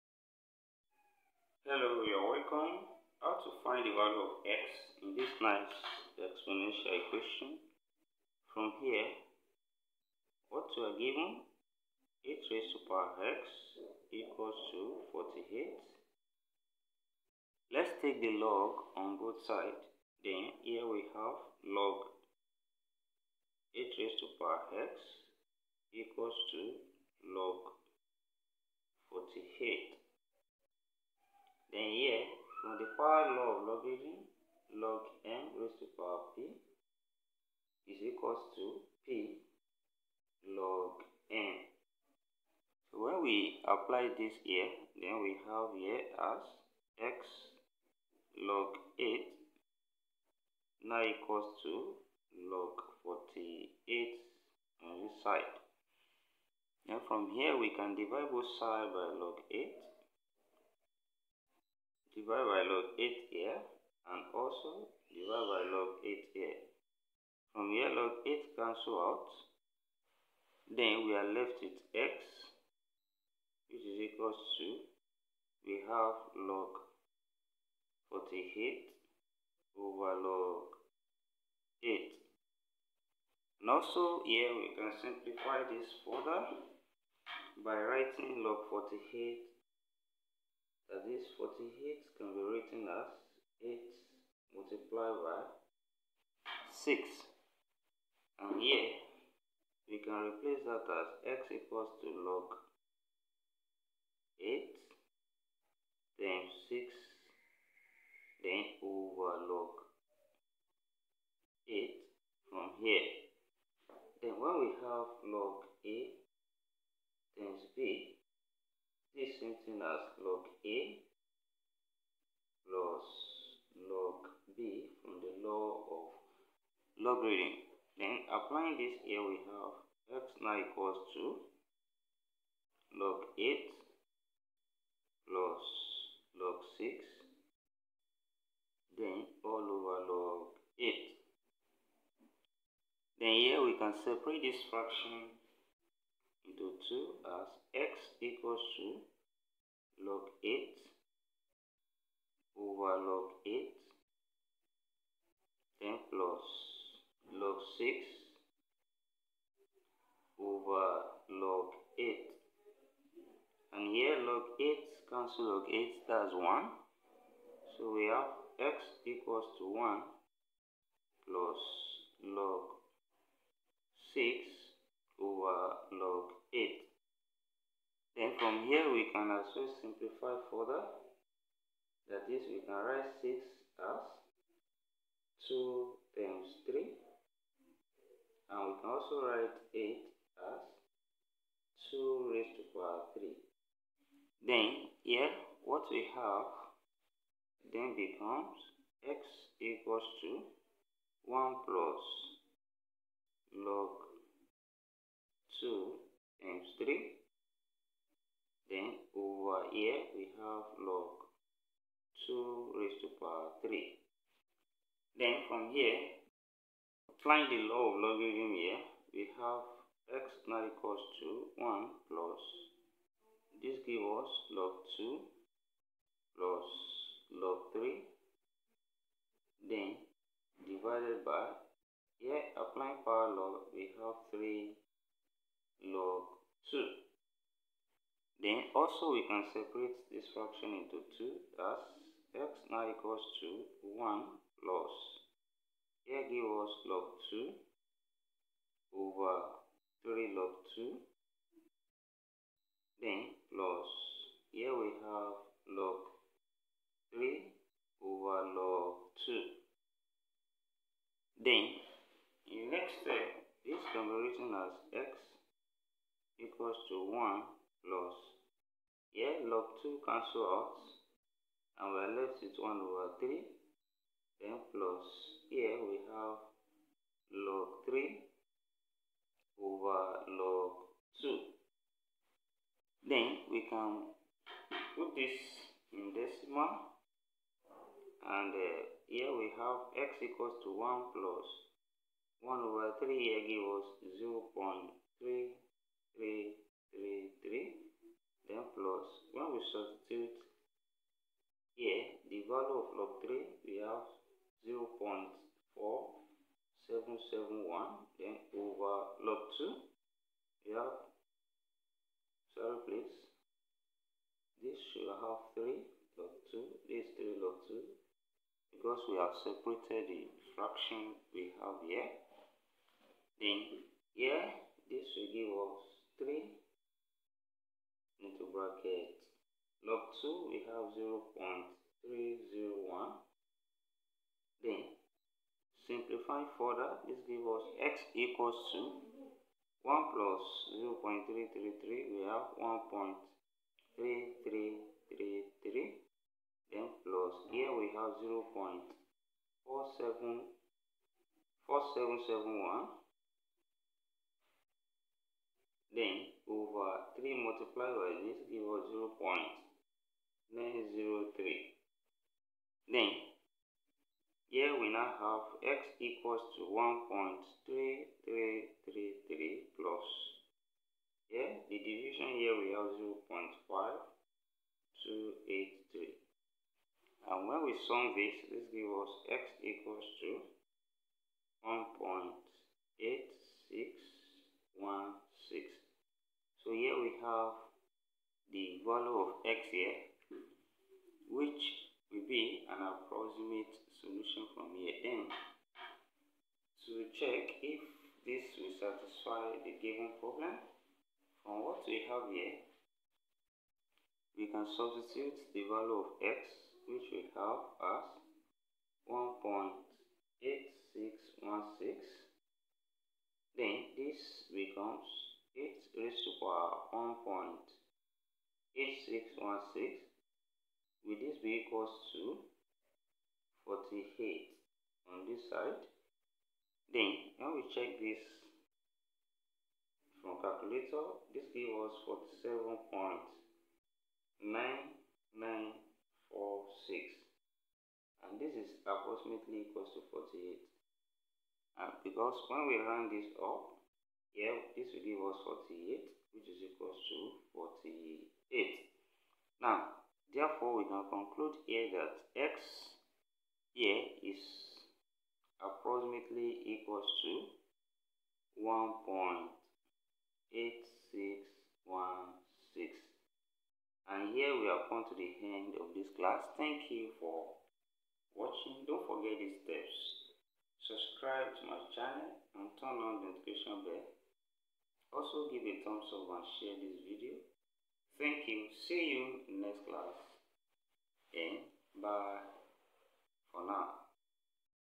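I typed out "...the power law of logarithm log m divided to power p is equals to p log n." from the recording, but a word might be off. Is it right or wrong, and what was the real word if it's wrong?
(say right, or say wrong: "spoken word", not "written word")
wrong: "raised", not "divided".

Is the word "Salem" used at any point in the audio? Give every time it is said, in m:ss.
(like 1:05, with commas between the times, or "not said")
not said.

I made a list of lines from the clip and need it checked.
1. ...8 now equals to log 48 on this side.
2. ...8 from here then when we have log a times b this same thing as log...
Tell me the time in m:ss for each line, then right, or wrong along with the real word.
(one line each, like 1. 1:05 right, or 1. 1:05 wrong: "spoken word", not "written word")
1. 0:48 right
2. 1:51 right.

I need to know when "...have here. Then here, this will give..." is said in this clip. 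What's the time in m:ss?
5:21.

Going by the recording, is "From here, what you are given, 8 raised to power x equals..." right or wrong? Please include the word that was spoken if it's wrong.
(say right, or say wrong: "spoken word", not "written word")
right.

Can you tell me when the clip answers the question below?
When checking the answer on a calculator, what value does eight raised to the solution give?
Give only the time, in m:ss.
7:14.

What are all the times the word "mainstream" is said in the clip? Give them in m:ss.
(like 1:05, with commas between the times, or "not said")
not said.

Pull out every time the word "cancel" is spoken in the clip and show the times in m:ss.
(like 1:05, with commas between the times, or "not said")
1:08, 2:45, 4:30.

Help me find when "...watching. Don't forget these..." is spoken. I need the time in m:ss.
7:48.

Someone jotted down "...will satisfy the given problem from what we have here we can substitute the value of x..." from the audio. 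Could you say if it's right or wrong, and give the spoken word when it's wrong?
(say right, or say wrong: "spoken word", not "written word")
right.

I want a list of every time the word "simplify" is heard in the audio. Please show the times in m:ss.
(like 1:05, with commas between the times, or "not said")
1:25, 2:59, 5:35.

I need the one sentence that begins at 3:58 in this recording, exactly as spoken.
Then also we can separate this fraction into 2 as x now equals to 1 plus.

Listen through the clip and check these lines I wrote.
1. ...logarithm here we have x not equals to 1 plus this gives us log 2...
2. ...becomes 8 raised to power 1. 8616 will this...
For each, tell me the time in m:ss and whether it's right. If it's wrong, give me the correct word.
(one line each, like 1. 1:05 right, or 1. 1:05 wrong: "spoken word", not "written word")
1. 3:38 right
2. 6:54 right.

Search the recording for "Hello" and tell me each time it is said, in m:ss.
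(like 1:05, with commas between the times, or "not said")
0:01.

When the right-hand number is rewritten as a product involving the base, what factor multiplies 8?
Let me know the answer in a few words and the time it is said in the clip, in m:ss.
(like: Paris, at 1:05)
6, at 1:33.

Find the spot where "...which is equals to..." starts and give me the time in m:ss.
7:26.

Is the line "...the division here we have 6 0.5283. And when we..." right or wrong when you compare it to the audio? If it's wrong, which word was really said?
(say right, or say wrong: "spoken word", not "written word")
wrong: "0", not "6".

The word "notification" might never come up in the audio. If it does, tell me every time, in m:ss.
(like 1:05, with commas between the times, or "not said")
7:53.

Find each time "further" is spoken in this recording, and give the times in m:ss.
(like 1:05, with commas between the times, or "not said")
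1:26, 3:00, 5:36.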